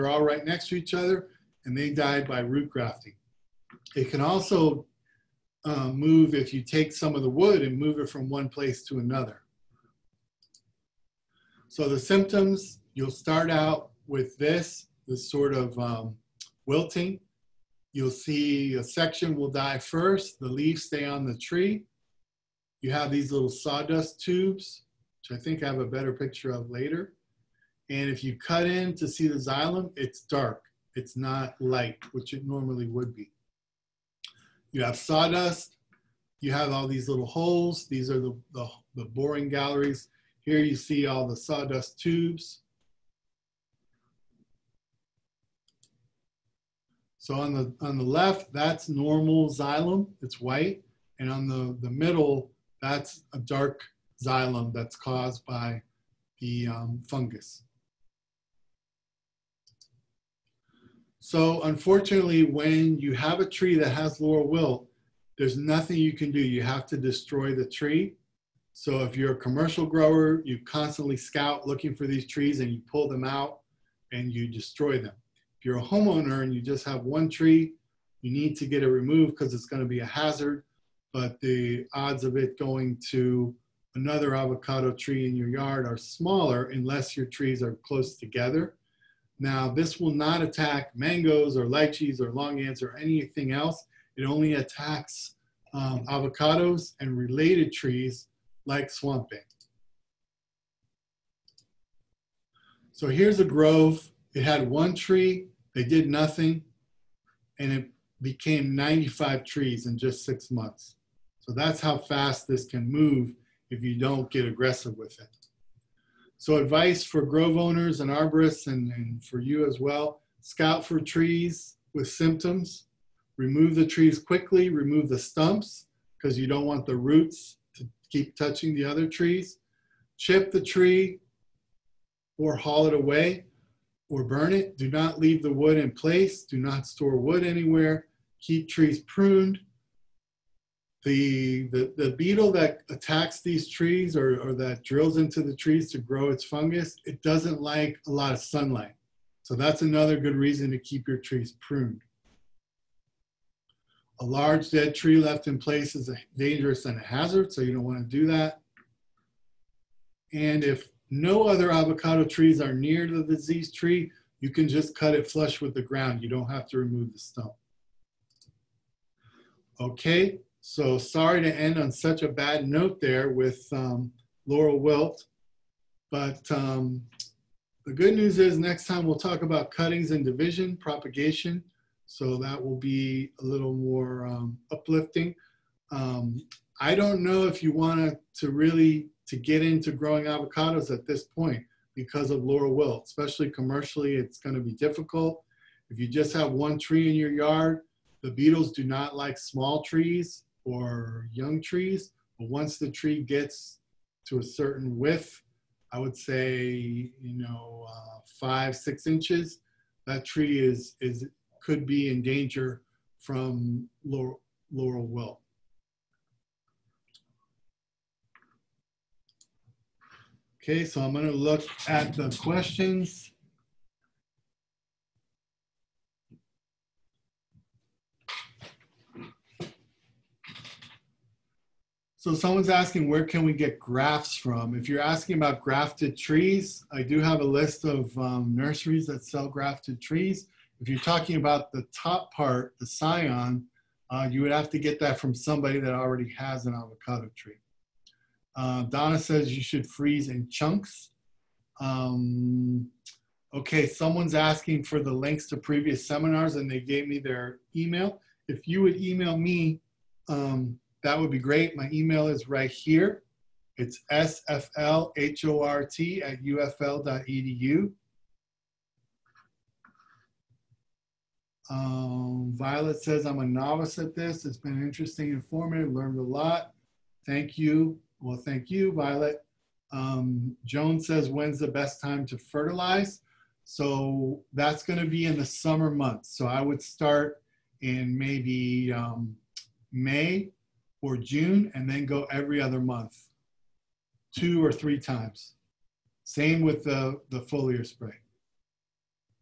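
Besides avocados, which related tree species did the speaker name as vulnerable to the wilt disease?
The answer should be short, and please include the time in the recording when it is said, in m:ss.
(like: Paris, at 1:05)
swamp bay, at 1:38.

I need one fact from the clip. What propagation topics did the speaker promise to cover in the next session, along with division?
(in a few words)
cuttings.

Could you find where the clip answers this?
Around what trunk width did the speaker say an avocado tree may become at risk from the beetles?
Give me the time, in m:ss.
3:28.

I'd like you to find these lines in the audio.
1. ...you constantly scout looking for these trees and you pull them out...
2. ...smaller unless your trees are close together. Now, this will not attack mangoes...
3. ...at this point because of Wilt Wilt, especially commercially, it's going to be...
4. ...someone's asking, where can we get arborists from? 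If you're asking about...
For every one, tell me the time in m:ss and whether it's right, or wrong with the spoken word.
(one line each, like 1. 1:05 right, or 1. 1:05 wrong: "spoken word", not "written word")
1. 1:10 right
2. 1:25 right
3. 3:10 wrong: "Laurel", not "Wilt"
4. 3:52 wrong: "grafts", not "arborists".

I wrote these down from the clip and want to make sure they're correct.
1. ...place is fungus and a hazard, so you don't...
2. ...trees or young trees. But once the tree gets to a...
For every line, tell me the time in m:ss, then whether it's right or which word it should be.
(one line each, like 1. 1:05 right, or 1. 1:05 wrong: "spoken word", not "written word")
1. 2:35 wrong: "dangerous", not "fungus"
2. 3:19 right.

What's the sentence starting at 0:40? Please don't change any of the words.
Here you see all the sawdust tubes.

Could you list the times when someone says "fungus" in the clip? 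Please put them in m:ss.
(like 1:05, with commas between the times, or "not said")
0:57, 2:26.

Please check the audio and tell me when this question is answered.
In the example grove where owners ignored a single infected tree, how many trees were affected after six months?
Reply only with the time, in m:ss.
1:48.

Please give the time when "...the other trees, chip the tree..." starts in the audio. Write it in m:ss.
2:08.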